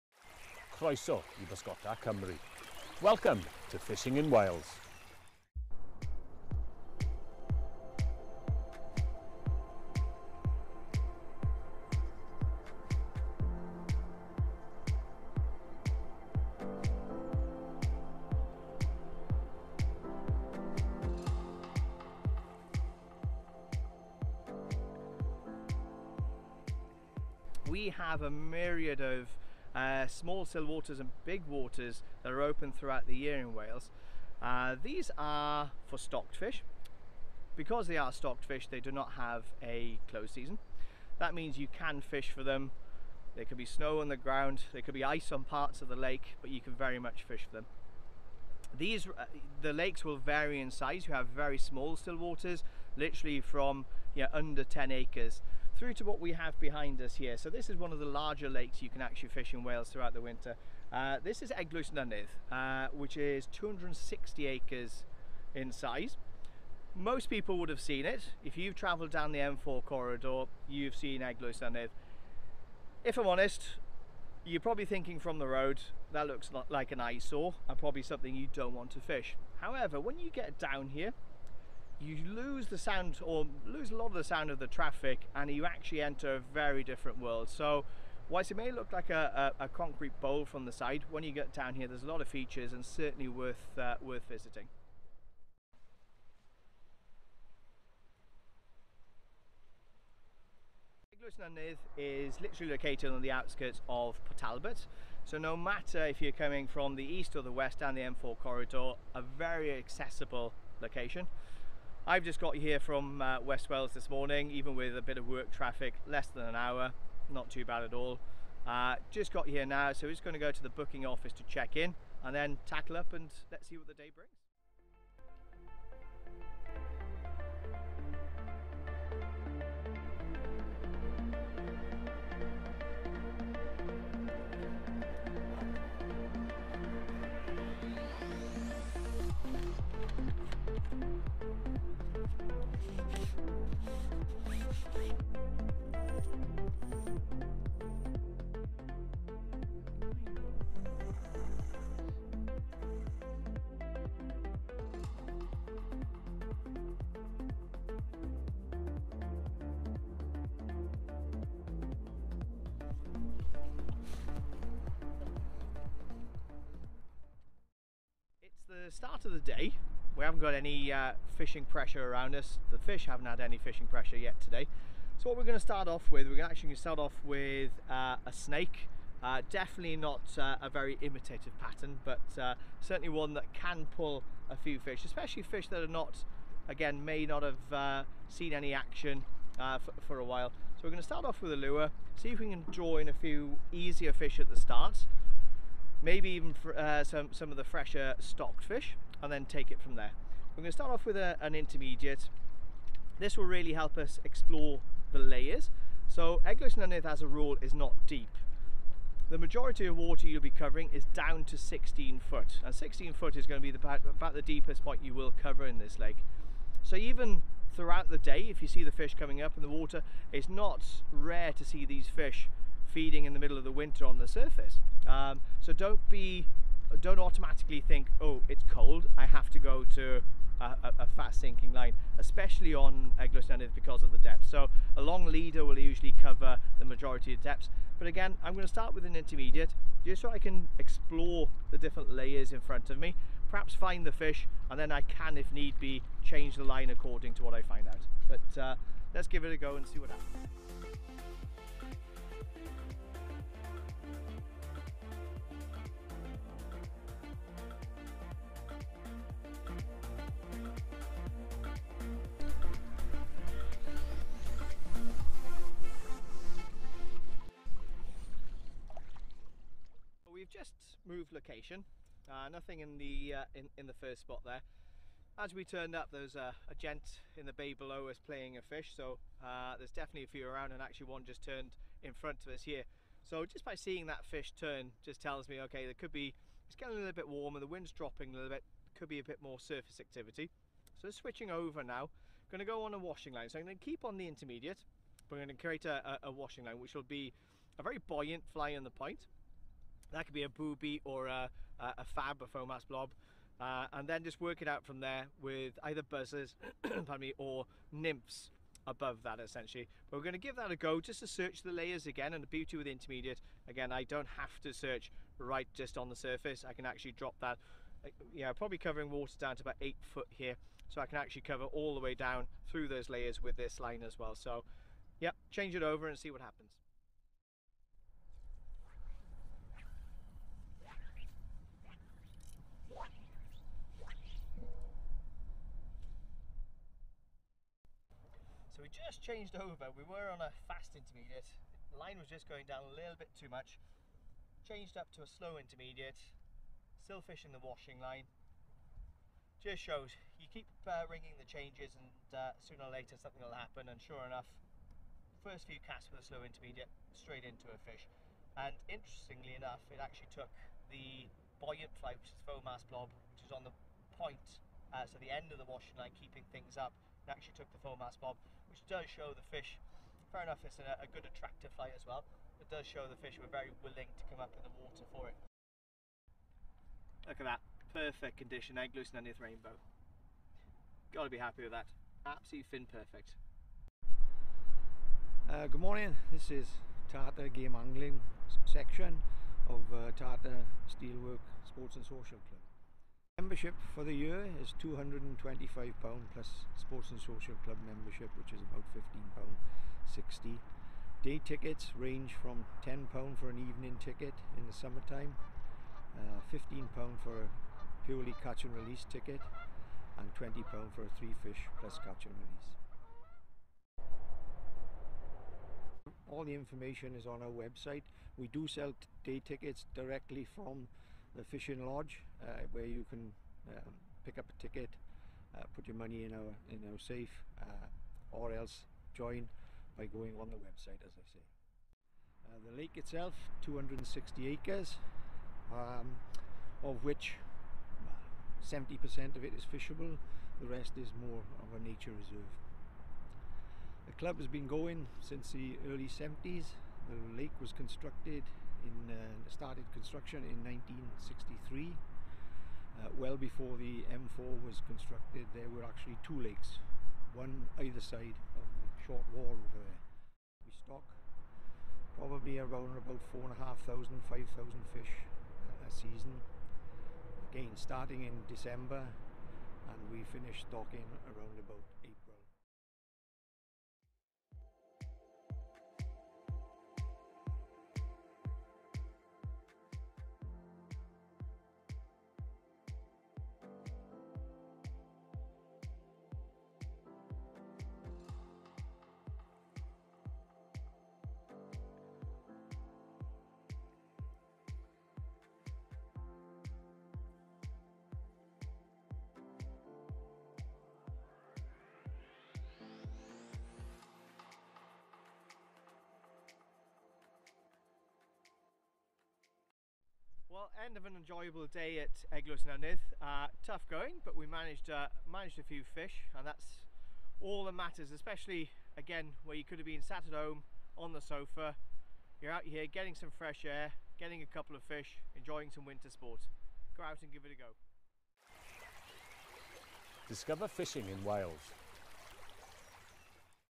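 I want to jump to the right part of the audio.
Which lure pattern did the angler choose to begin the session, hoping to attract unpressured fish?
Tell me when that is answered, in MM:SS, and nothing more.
02:58.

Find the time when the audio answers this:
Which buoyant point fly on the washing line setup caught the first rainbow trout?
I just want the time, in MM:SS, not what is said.
06:02.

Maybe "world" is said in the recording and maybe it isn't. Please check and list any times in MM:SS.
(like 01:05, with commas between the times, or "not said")
01:27.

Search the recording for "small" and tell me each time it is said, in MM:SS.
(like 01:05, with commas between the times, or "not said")
00:30, 00:51.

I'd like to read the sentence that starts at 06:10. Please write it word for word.
Fair enough, it's a, a good attractive bite as well.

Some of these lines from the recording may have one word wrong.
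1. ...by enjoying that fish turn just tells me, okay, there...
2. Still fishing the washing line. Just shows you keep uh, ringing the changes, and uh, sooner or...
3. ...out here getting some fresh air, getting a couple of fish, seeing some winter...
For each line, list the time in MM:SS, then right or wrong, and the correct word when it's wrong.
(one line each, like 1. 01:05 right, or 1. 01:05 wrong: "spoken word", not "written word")
1. 04:43 wrong: "seeing", not "enjoying"
2. 05:46 right
3. 08:42 wrong: "enjoying", not "seeing".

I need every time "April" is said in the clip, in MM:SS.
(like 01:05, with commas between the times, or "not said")
07:52.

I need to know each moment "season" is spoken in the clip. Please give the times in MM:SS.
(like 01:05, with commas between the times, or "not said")
00:40, 07:45.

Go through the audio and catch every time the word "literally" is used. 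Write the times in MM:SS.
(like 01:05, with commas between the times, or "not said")
00:52, 01:42.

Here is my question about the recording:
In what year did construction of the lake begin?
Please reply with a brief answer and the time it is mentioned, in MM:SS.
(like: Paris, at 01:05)
1963, at 07:30.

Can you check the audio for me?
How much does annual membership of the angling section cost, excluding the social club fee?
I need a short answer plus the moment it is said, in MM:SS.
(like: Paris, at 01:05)
£225, at 06:34.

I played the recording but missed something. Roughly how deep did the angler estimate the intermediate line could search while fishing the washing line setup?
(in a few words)
8 foot.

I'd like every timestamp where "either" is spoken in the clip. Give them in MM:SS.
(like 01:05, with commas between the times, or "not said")
05:05, 07:37.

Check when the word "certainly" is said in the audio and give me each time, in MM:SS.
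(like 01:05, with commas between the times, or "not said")
01:32, 03:02.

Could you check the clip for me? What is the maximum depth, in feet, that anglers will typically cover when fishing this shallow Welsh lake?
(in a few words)
16 foot.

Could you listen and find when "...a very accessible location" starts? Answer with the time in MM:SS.
01:49.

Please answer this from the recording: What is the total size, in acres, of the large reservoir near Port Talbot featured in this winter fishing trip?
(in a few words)
260 acres.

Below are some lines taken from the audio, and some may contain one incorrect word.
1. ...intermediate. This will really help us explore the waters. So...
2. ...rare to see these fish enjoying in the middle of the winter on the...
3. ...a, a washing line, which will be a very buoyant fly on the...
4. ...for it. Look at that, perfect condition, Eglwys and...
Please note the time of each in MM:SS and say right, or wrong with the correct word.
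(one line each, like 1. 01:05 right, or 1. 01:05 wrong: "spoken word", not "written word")
1. 03:21 wrong: "layers", not "waters"
2. 03:41 wrong: "feeding", not "enjoying"
3. 04:56 right
4. 06:15 right.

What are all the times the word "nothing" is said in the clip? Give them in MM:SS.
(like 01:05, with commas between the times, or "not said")
04:32.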